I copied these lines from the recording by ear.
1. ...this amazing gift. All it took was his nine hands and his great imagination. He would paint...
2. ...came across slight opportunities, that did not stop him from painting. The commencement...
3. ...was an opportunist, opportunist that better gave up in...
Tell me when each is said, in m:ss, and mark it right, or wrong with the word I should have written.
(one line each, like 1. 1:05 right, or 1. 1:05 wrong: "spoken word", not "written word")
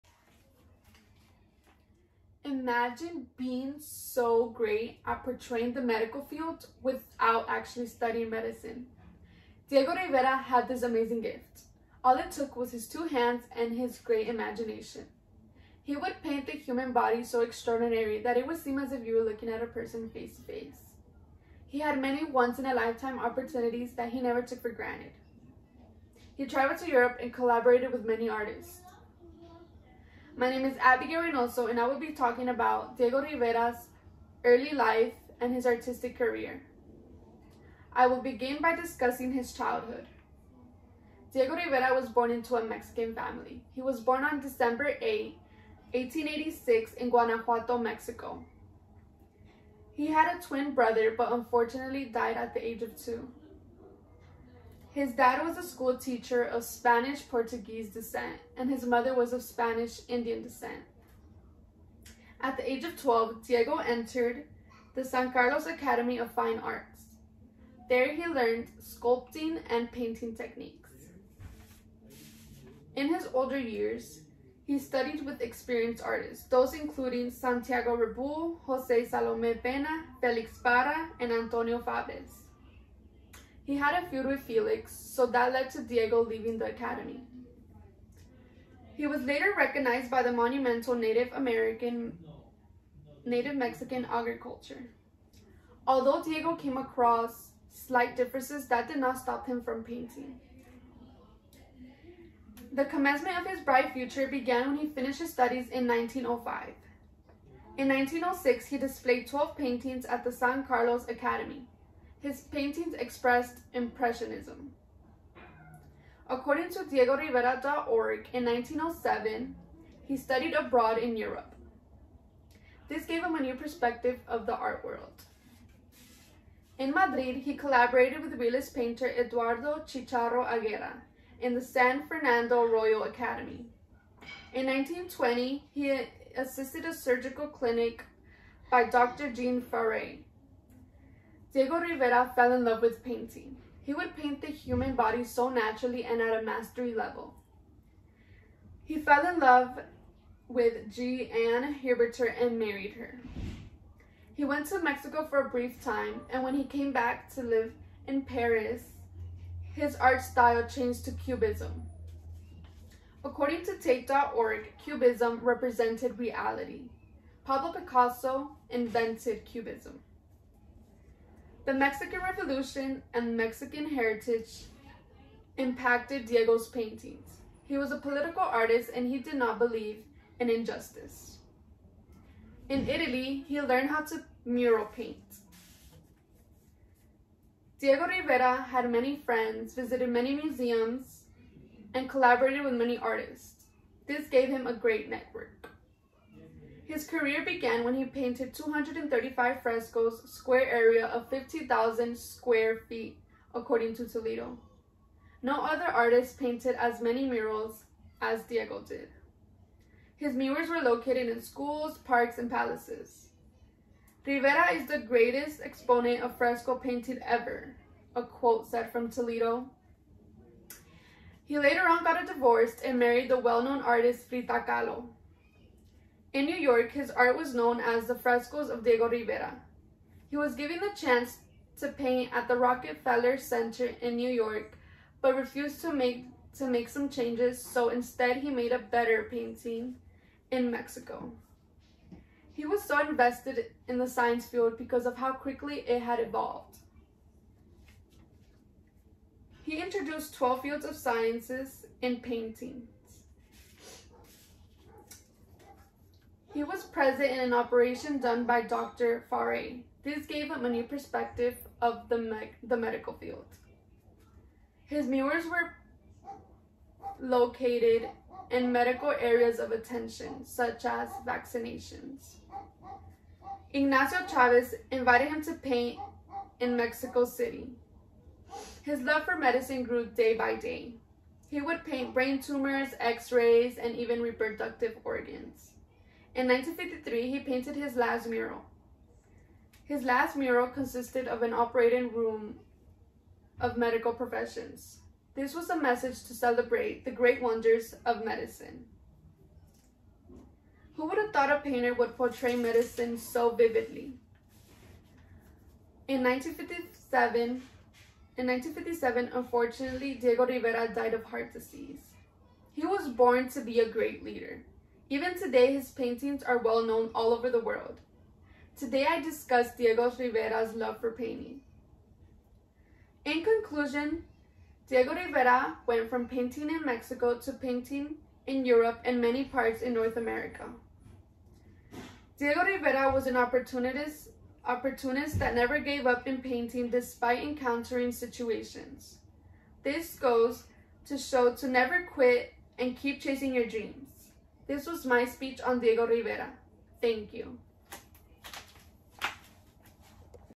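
1. 0:10 wrong: "two", not "nine"
2. 1:36 wrong: "differences", not "opportunities"
3. 5:33 wrong: "never", not "better".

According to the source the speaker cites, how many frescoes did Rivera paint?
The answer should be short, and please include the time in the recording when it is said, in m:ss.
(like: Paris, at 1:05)
235, at 3:18.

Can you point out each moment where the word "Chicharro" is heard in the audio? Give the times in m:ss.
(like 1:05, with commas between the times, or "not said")
2:09.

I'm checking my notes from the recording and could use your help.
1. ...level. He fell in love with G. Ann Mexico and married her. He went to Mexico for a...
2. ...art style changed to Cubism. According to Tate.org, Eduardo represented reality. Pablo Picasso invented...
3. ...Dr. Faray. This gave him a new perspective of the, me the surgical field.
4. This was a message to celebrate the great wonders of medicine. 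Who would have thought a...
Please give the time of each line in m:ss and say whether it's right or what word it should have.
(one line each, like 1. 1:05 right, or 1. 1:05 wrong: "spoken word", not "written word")
1. 2:26 wrong: "Huberter", not "Mexico"
2. 2:39 wrong: "Cubism", not "Eduardo"
3. 4:18 wrong: "medical", not "surgical"
4. 4:55 right.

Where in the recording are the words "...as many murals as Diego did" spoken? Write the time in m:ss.
3:26.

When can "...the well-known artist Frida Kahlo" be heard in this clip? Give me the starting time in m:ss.
3:43.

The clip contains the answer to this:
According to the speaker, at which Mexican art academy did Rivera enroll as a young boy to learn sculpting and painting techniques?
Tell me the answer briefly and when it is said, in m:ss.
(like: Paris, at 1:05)
San Carlos Academy of Fine Arts, at 1:05.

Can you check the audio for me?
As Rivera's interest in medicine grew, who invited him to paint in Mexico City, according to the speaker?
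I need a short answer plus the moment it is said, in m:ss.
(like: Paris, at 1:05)
Ignacio Chavez, at 4:33.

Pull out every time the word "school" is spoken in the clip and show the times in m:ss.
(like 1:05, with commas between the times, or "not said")
0:55, 3:31.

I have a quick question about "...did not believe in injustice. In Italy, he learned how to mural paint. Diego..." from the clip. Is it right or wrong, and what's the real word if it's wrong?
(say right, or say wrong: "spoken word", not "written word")
right.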